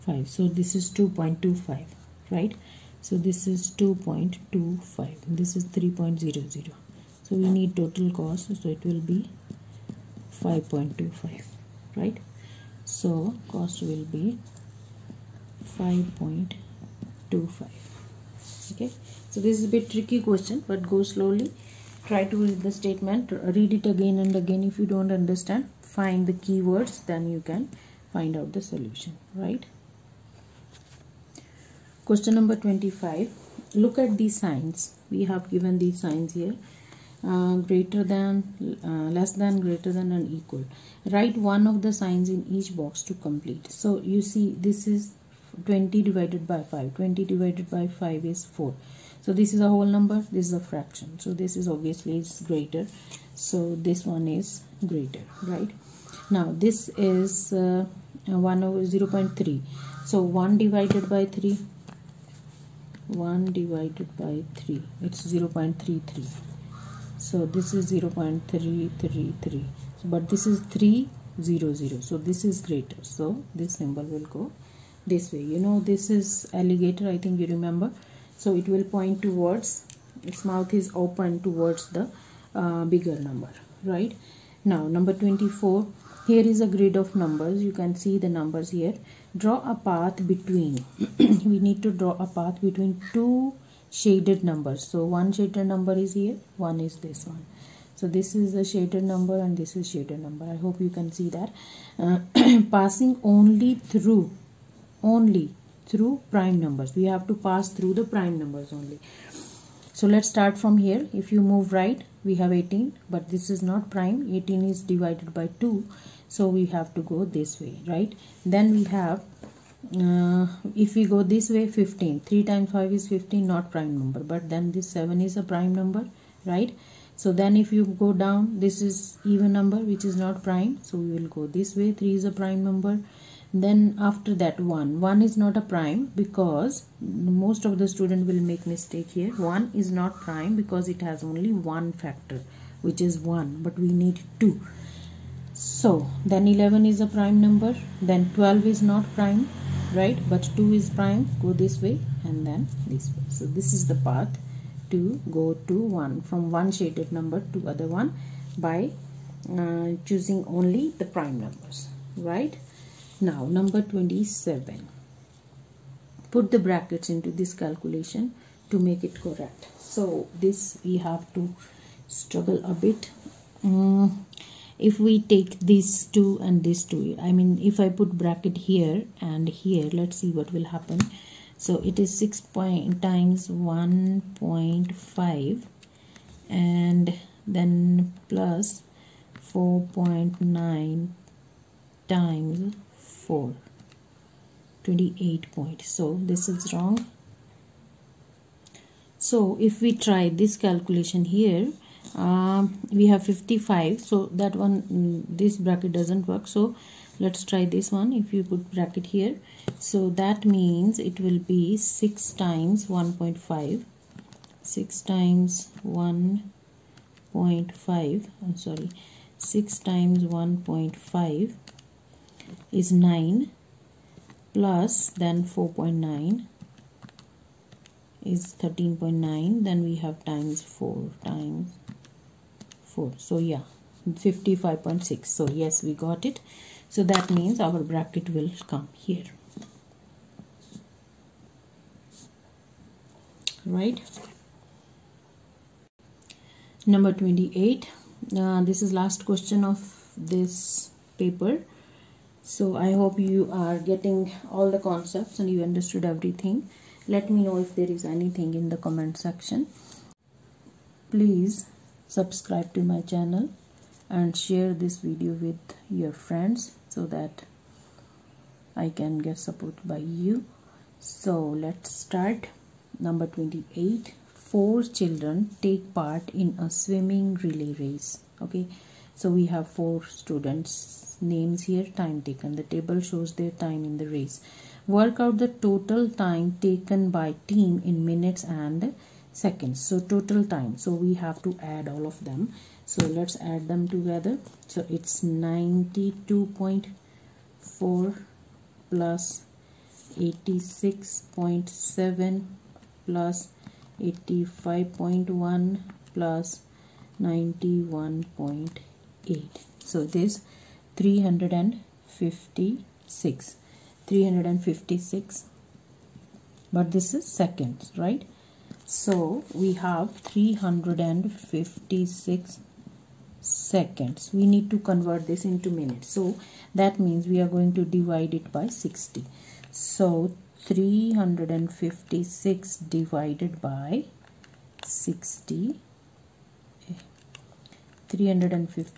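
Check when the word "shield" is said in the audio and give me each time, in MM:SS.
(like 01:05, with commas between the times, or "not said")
not said.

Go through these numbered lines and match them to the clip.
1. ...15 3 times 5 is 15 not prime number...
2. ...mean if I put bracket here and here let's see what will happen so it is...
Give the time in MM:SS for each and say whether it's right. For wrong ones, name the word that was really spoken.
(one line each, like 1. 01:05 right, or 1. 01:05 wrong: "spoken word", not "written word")
1. 02:01 right
2. 02:57 right.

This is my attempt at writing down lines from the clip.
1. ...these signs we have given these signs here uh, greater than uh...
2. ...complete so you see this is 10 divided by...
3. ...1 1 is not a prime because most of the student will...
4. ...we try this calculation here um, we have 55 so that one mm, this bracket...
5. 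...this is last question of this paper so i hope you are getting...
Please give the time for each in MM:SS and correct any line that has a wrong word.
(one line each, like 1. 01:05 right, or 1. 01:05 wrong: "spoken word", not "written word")
1. 00:34 right
2. 00:43 wrong: "20", not "10"
3. 02:14 right
4. 03:19 right
5. 04:08 right.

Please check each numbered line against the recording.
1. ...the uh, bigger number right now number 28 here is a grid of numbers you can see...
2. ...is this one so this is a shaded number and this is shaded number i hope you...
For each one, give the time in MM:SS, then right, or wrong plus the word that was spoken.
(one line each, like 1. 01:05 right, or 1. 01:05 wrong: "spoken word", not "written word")
1. 01:21 wrong: "24", not "28"
2. 01:36 right.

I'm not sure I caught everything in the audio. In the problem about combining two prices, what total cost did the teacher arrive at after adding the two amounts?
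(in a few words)
5.25.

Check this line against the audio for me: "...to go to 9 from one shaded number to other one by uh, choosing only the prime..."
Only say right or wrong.
wrong.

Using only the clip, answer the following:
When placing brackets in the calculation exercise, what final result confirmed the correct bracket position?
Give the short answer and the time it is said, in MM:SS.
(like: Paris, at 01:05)
55.6, at 03:54.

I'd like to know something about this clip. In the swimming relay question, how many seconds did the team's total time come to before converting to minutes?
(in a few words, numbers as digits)
356.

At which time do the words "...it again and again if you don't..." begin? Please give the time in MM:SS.
00:23.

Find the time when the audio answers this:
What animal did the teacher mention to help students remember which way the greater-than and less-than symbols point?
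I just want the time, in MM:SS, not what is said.
01:16.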